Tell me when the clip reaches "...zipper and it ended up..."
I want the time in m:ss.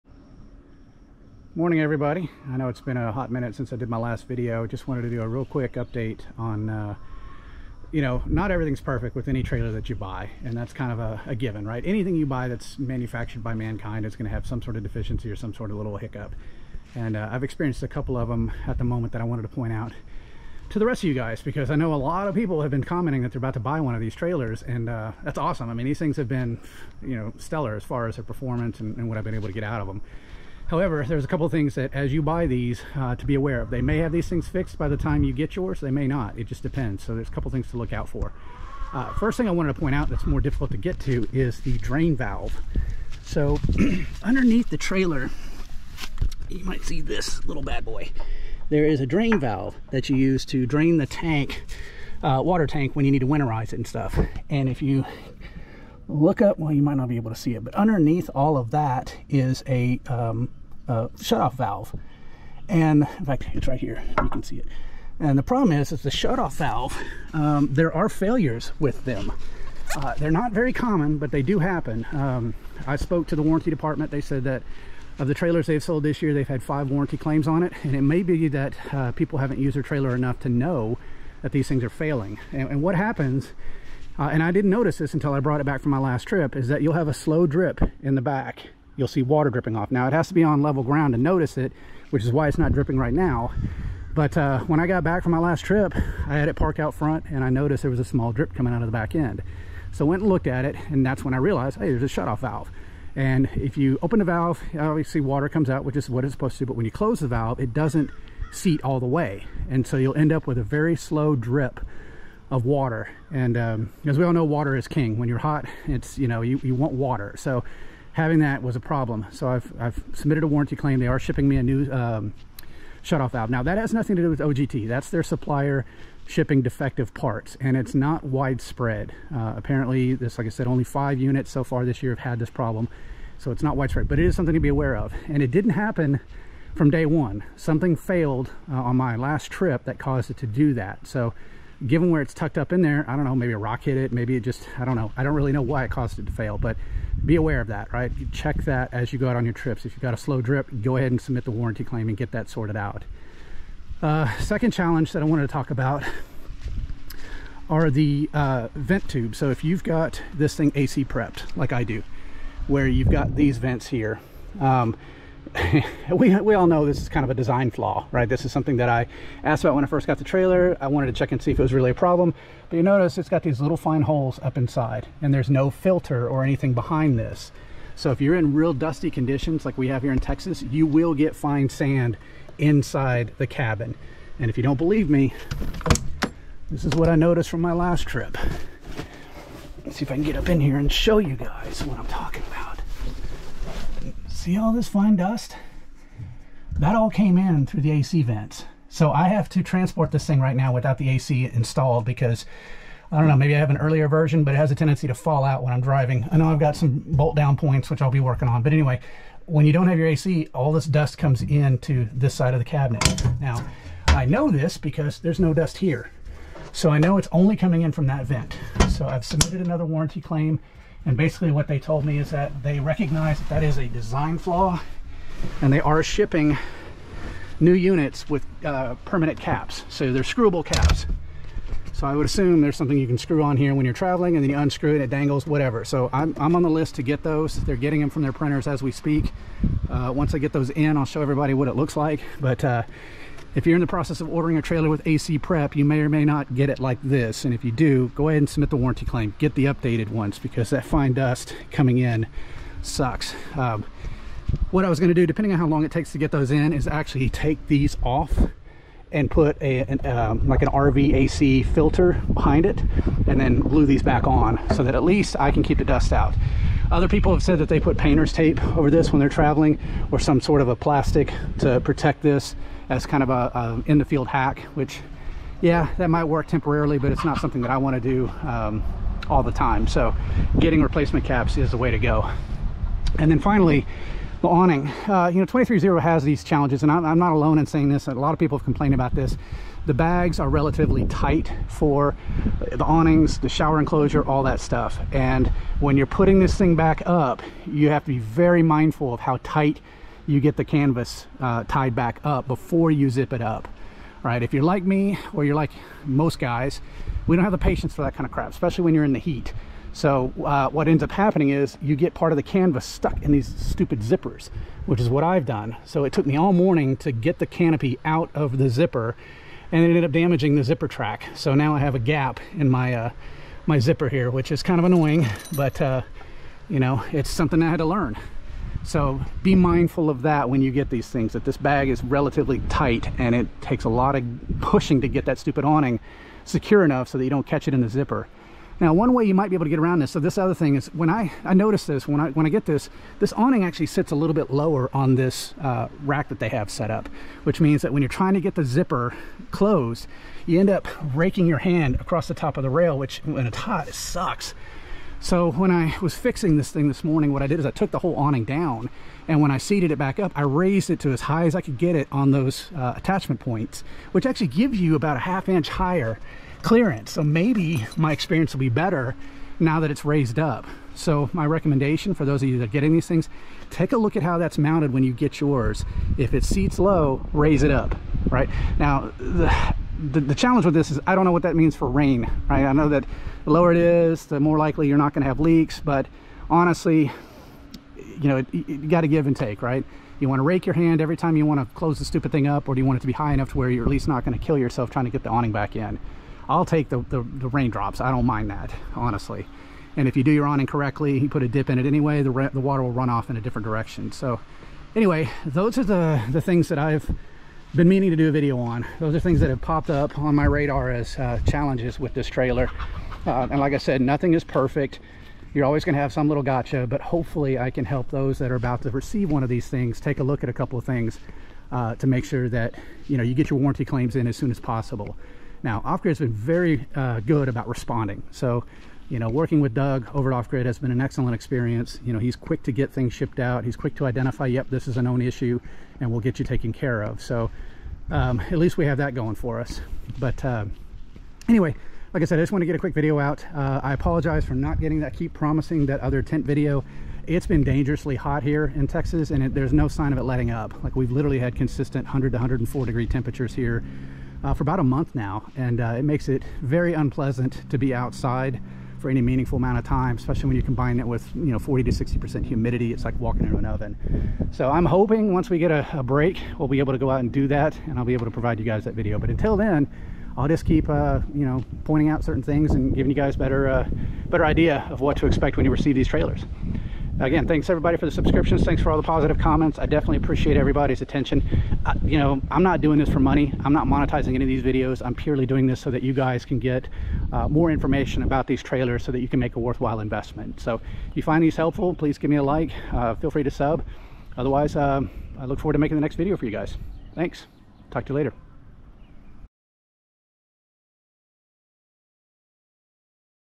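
5:18.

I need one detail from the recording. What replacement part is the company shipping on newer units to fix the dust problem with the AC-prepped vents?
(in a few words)
Screwable caps.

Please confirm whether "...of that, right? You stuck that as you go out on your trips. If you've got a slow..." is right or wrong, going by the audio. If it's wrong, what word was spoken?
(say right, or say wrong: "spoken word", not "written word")
wrong: "check", not "stuck".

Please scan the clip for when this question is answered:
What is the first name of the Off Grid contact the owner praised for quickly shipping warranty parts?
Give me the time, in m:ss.
7:09.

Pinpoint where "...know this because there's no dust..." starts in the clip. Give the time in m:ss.
3:34.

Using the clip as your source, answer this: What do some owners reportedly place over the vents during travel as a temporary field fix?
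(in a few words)
Painter's tape.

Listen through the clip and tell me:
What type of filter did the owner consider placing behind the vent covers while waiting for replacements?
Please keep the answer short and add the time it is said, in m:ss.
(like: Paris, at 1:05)
RV AC filter, at 4:20.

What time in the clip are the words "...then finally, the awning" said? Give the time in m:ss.
4:43.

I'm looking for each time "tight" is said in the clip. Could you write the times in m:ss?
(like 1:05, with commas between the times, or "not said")
4:51, 4:59, 5:32.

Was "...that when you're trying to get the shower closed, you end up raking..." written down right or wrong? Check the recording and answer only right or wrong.
wrong.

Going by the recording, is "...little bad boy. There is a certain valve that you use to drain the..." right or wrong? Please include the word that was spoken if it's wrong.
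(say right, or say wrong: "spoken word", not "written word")
wrong: "drain", not "certain".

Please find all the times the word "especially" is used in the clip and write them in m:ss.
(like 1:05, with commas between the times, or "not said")
5:08, 7:40.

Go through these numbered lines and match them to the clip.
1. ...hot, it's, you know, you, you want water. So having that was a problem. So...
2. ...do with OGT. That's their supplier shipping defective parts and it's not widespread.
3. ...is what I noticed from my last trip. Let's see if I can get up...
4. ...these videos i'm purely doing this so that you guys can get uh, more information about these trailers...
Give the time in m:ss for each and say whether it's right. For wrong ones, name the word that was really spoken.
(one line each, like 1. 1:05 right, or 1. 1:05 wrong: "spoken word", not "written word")
1. 1:55 right
2. 2:04 right
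3. 3:06 right
4. 8:04 right.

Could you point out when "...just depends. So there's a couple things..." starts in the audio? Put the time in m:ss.
0:36.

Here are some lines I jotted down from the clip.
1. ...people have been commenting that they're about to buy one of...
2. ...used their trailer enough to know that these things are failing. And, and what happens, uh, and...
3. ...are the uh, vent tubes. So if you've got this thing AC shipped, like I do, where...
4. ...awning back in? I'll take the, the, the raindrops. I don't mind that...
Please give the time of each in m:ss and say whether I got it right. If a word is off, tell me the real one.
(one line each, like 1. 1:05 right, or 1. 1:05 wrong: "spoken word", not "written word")
1. 0:22 right
2. 1:19 right
3. 2:37 wrong: "prepped", not "shipped"
4. 6:35 right.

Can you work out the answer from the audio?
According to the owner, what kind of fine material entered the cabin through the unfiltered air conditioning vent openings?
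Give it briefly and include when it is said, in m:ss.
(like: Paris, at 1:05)
Fine sand, at 3:01.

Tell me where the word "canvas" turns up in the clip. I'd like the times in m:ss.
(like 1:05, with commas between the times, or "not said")
5:00, 5:12.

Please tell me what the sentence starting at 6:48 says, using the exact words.
Those are things that have popped up on my radar as uh, challenges with this trailer.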